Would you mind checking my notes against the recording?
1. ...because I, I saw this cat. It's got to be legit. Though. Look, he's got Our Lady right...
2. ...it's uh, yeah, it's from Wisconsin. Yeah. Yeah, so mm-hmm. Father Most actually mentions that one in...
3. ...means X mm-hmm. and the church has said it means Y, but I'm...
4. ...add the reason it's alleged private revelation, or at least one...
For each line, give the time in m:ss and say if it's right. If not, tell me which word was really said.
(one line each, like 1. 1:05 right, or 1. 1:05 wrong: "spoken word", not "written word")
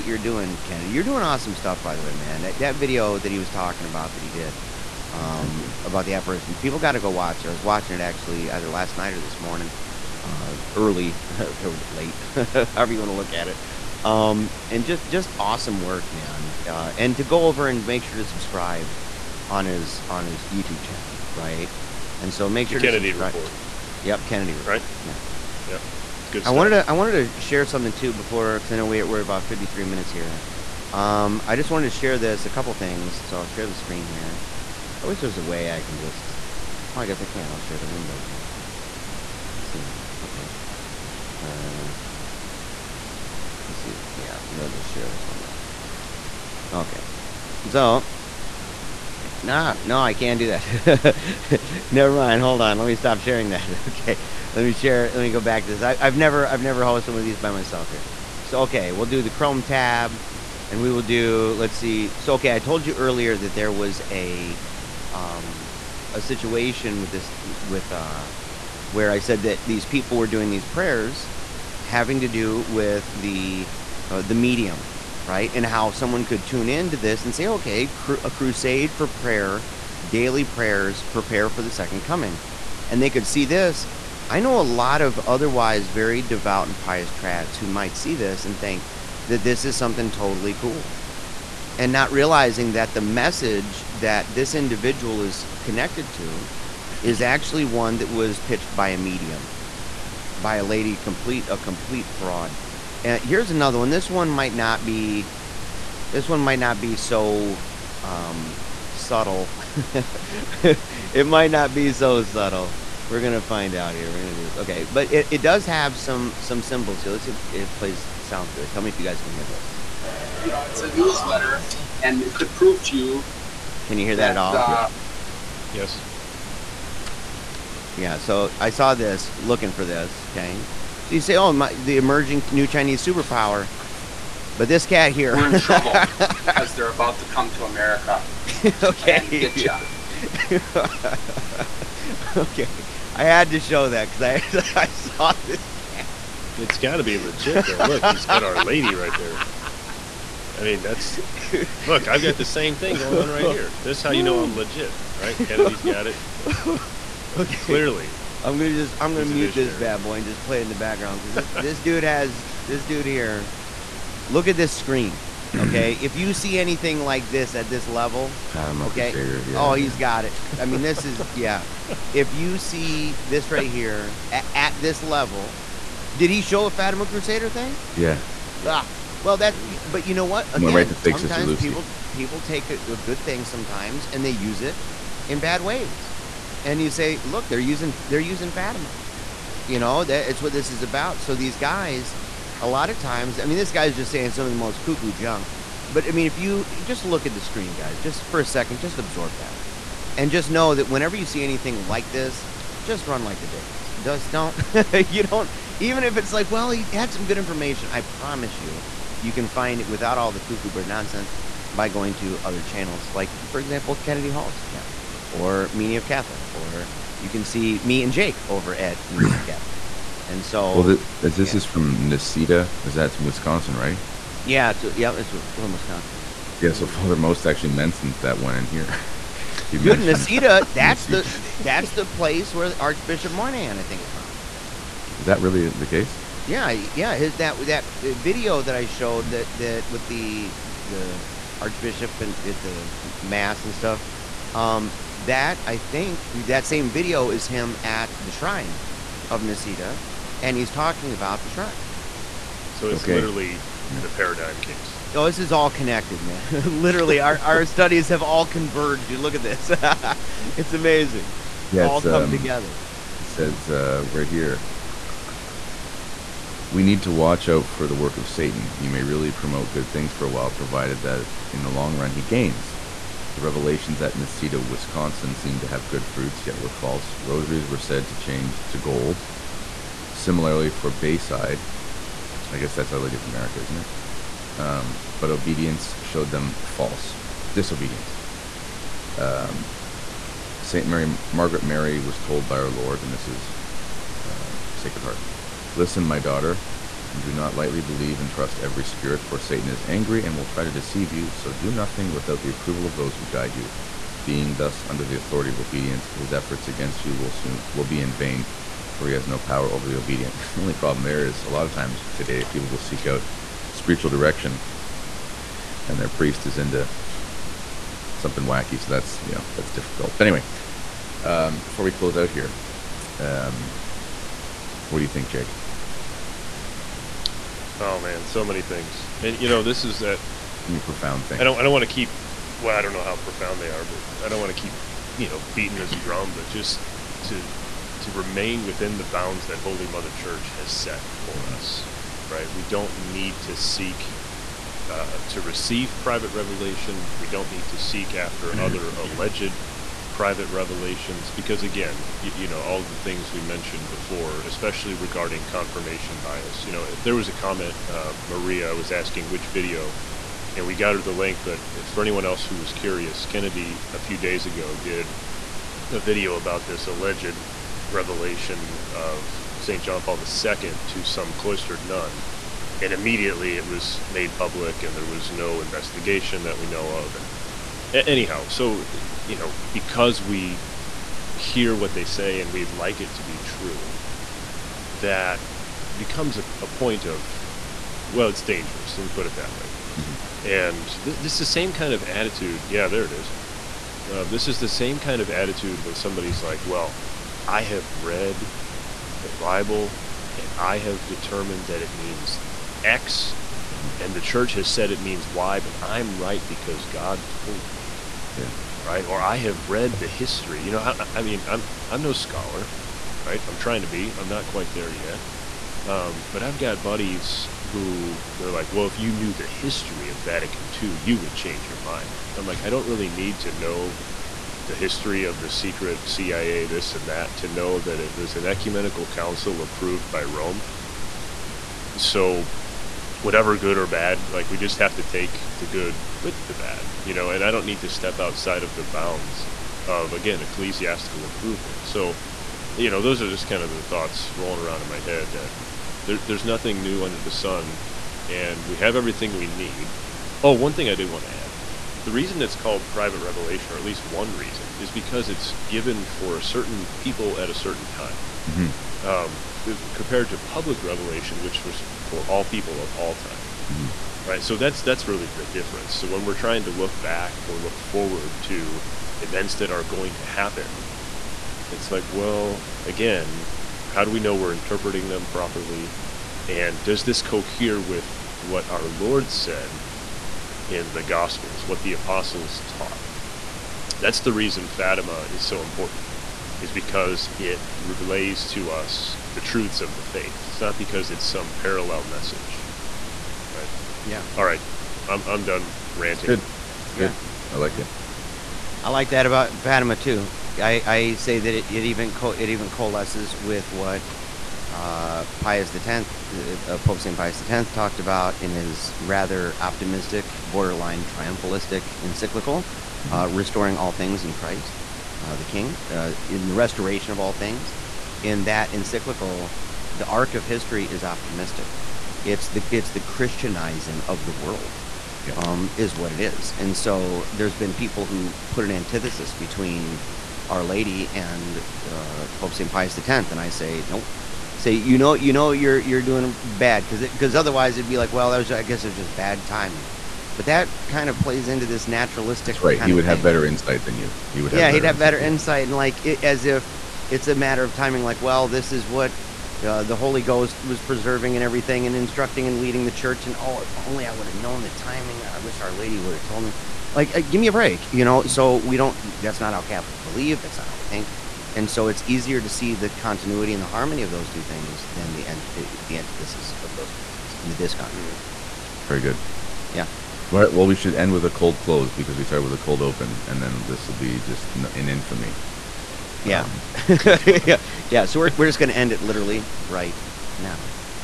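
1. 2:24 right
2. 3:44 right
3. 6:41 right
4. 7:31 wrong: "called", not "alleged".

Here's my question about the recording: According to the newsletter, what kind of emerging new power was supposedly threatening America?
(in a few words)
Chinese superpower.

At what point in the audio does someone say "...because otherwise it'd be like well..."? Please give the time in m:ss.
8:57.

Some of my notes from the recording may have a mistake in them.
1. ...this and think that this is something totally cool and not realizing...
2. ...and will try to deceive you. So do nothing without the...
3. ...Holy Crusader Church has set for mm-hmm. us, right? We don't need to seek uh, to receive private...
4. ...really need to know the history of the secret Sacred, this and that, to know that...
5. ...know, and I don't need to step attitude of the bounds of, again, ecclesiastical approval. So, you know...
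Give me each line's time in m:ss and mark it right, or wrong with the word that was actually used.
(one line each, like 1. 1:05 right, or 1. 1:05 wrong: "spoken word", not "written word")
1. 1:28 right
2. 5:00 right
3. 5:39 wrong: "Mother", not "Crusader"
4. 7:02 wrong: "CIA", not "Sacred"
5. 7:17 wrong: "outside", not "attitude".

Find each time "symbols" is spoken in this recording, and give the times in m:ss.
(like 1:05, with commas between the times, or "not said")
1:56.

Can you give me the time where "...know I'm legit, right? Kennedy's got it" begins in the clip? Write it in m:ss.
2:34.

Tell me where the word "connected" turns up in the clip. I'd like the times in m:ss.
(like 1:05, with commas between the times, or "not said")
1:35, 4:15.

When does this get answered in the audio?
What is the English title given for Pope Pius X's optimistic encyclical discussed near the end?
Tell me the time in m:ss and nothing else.
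8:33.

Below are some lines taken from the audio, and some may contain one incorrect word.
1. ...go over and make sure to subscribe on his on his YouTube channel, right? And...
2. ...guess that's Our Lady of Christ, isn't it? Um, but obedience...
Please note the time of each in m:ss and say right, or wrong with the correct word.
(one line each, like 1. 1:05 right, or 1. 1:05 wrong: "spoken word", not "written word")
1. 0:17 right
2. 4:42 wrong: "America", not "Christ".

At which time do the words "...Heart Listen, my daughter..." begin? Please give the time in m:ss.
4:55.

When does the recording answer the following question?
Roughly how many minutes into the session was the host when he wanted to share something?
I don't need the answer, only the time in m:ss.
0:29.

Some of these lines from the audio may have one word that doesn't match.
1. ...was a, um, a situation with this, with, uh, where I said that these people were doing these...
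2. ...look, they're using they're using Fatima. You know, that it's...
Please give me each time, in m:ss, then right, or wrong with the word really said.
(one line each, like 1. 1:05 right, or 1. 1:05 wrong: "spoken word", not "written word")
1. 1:03 right
2. 3:07 right.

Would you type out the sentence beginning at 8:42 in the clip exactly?
It's the it's the Christianizing of the world, yeah.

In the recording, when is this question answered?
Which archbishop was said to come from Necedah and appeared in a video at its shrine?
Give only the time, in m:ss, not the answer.
3:52.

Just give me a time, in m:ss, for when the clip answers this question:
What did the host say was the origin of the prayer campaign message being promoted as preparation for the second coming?
1:38.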